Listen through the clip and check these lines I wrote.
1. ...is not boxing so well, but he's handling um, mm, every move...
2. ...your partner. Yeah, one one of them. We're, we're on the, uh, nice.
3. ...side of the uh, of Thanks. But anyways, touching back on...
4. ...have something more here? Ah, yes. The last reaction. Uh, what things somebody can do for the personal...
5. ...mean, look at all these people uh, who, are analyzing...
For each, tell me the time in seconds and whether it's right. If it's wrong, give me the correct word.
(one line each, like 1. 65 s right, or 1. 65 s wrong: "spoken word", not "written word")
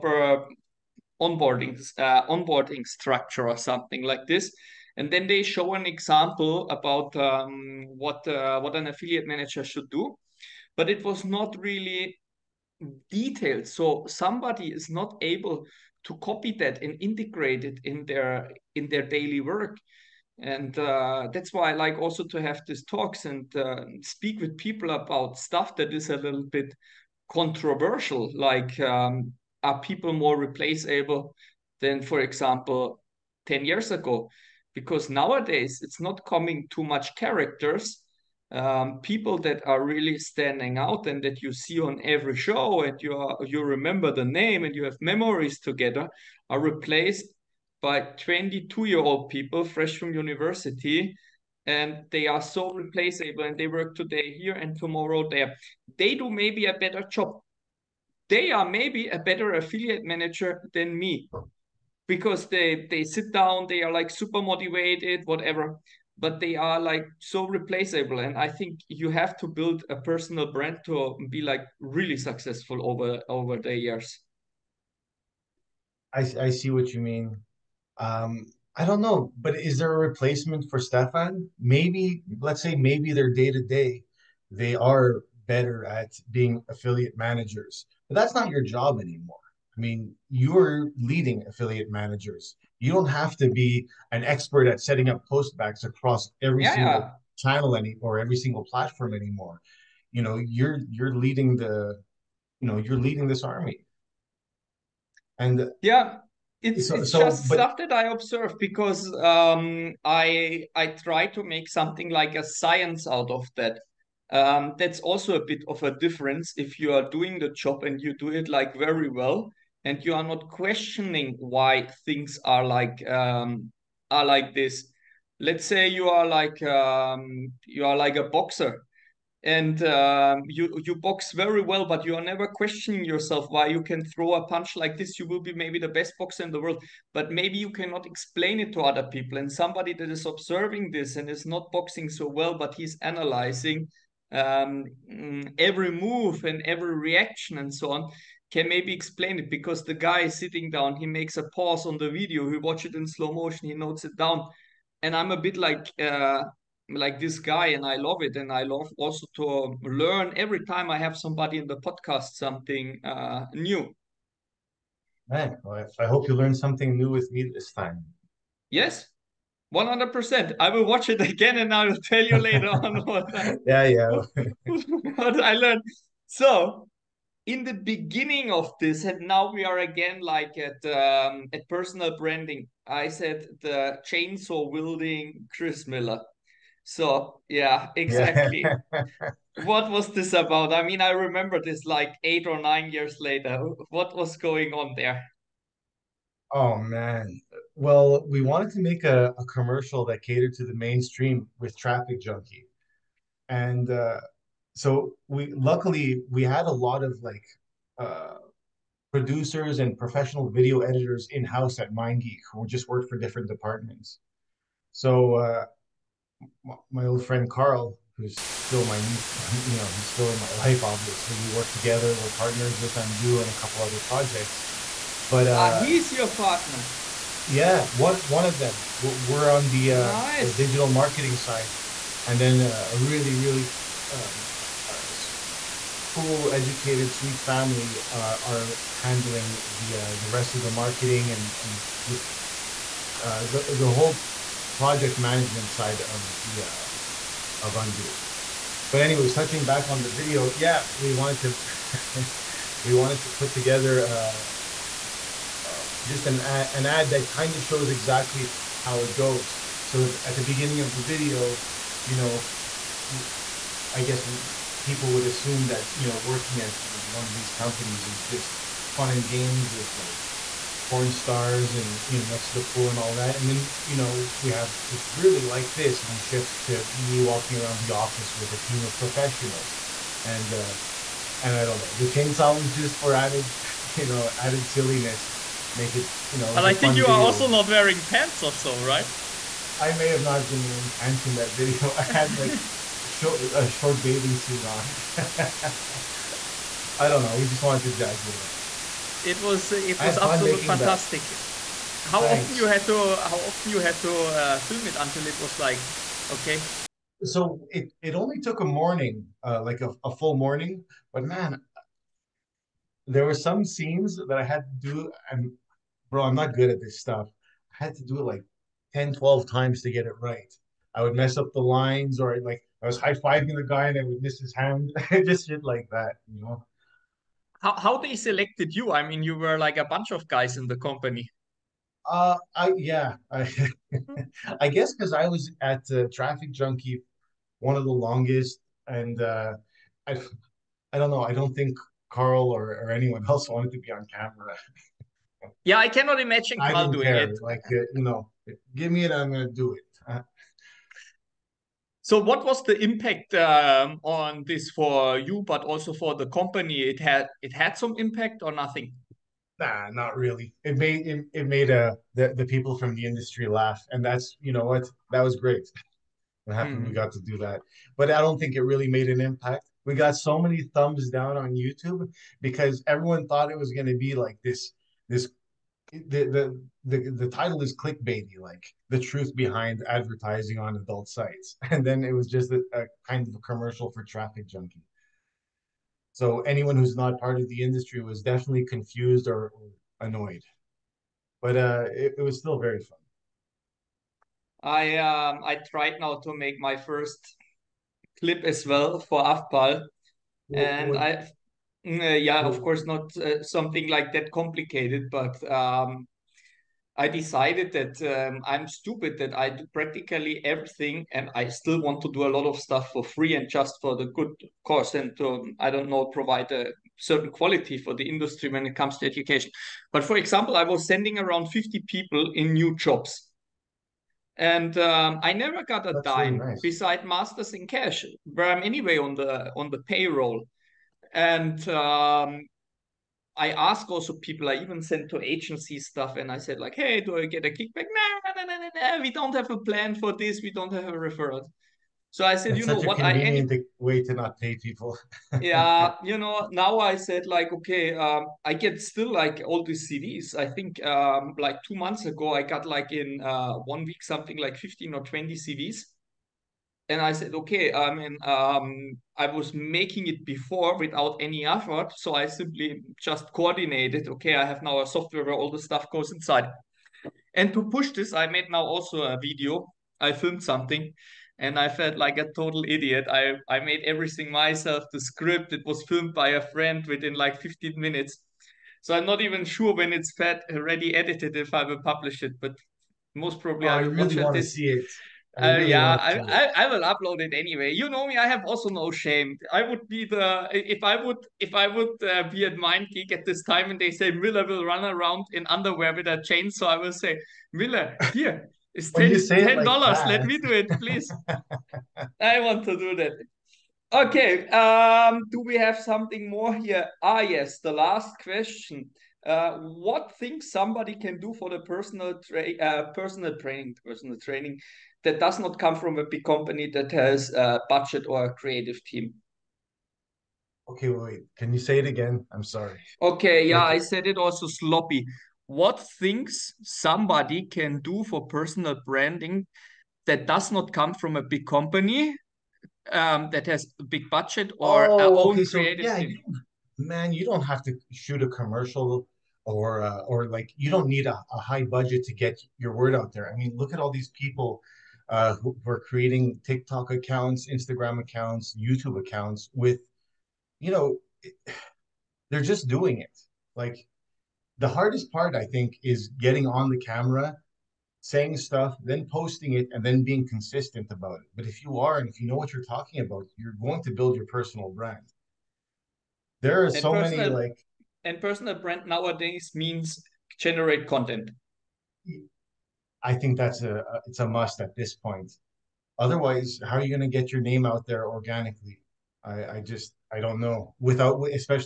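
1. 141 s wrong: "analyzing", not "handling"
2. 226 s right
3. 245 s wrong: "Undoo", not "Thanks"
4. 505 s wrong: "question", not "reaction"
5. 543 s wrong: "creating", not "analyzing".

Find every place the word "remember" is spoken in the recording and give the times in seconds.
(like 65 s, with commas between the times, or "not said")
43 s, 191 s.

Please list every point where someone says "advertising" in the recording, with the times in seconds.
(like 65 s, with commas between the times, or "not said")
379 s.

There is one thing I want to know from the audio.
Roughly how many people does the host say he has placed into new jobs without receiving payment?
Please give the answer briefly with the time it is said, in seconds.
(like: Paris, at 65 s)
50, at 421 s.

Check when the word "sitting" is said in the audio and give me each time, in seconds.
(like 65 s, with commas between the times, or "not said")
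150 s.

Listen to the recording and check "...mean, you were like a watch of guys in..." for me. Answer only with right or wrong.
wrong.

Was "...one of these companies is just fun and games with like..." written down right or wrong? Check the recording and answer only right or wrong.
right.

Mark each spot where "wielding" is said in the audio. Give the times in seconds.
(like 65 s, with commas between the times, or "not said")
184 s.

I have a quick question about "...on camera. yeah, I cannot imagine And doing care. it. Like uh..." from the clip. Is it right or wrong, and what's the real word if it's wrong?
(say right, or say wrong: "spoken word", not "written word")
wrong: "Carl", not "And".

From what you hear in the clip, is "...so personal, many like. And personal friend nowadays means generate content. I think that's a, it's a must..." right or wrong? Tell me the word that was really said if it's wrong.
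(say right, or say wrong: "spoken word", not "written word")
wrong: "brand", not "friend".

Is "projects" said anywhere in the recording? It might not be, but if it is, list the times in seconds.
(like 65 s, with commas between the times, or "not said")
224 s, 244 s.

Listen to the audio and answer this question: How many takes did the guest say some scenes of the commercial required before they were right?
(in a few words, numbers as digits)
10 to 12.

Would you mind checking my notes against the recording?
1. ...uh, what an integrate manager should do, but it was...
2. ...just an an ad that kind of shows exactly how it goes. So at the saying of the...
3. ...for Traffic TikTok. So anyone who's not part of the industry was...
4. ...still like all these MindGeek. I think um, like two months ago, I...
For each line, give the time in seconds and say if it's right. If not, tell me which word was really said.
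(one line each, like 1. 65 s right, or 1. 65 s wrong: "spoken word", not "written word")
1. 8 s wrong: "affiliate", not "integrate"
2. 256 s wrong: "beginning", not "saying"
3. 383 s wrong: "Junkie", not "TikTok"
4. 448 s wrong: "CDs", not "MindGeek".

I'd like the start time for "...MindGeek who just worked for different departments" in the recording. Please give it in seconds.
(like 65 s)
211 s.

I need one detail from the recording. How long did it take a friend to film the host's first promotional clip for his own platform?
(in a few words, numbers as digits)
15 minutes.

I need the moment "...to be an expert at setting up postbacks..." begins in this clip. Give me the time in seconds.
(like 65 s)
93 s.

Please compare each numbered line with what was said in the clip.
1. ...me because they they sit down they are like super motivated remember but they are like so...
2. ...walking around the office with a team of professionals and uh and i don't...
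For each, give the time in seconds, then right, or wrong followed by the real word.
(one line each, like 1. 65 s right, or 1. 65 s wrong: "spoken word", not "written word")
1. 60 s wrong: "whatever", not "remember"
2. 277 s right.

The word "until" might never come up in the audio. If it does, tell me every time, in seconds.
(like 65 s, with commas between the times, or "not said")
304 s.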